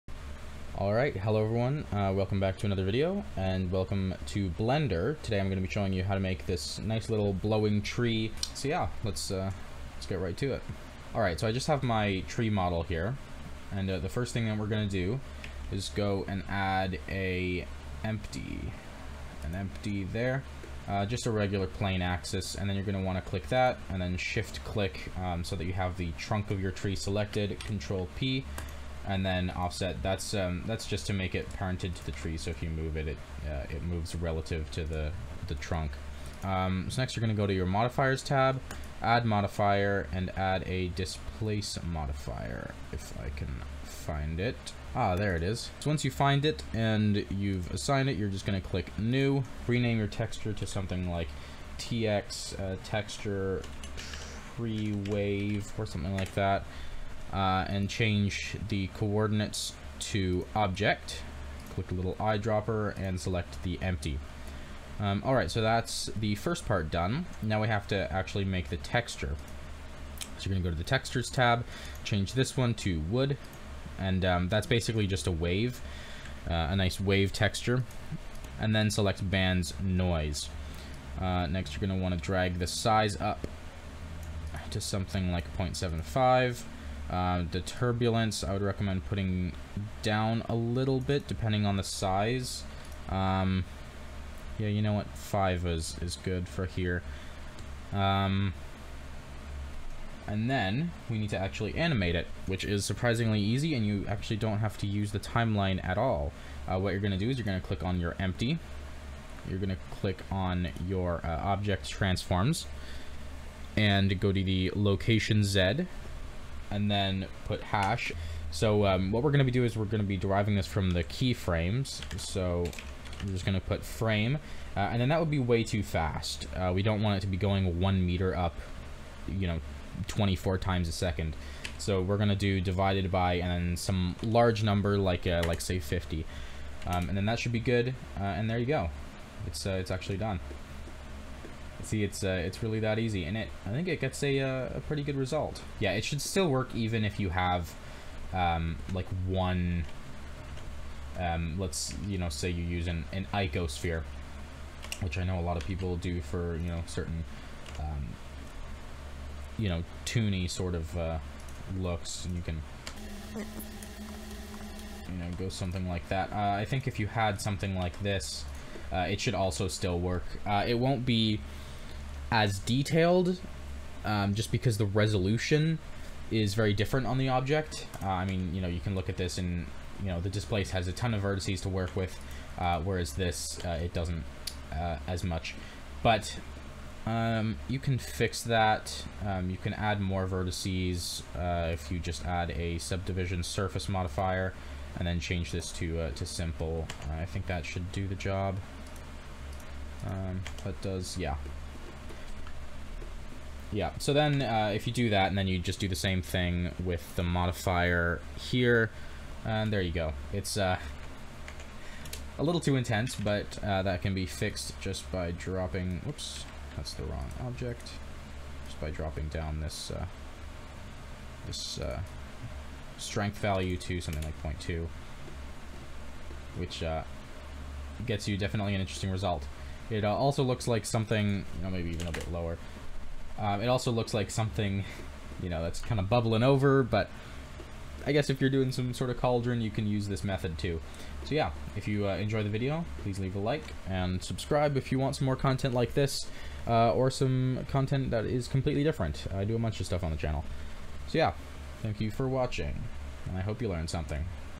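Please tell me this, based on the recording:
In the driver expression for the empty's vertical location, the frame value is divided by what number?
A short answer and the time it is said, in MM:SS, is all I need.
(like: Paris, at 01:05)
50, at 02:15.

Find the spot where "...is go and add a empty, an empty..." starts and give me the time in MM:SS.
00:15.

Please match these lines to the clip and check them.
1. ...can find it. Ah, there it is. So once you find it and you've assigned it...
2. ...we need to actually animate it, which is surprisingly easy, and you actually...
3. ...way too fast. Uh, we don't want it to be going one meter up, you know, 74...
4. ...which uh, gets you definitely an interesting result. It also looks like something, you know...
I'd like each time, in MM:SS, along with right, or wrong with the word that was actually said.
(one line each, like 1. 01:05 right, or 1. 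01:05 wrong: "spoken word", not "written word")
1. 00:43 right
2. 01:41 right
3. 02:05 wrong: "24", not "74"
4. 03:46 right.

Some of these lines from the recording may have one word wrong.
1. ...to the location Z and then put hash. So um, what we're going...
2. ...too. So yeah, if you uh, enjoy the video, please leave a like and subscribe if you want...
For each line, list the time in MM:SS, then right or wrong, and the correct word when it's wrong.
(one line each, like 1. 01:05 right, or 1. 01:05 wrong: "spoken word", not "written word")
1. 01:54 right
2. 04:00 right.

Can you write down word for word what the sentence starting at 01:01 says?
Click a little eyedropper and select the empty.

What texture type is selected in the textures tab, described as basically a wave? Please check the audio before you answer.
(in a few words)
Wood.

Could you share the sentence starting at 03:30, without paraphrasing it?
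It's uh, a little too intense, but uh, that can be fixed just by dropping...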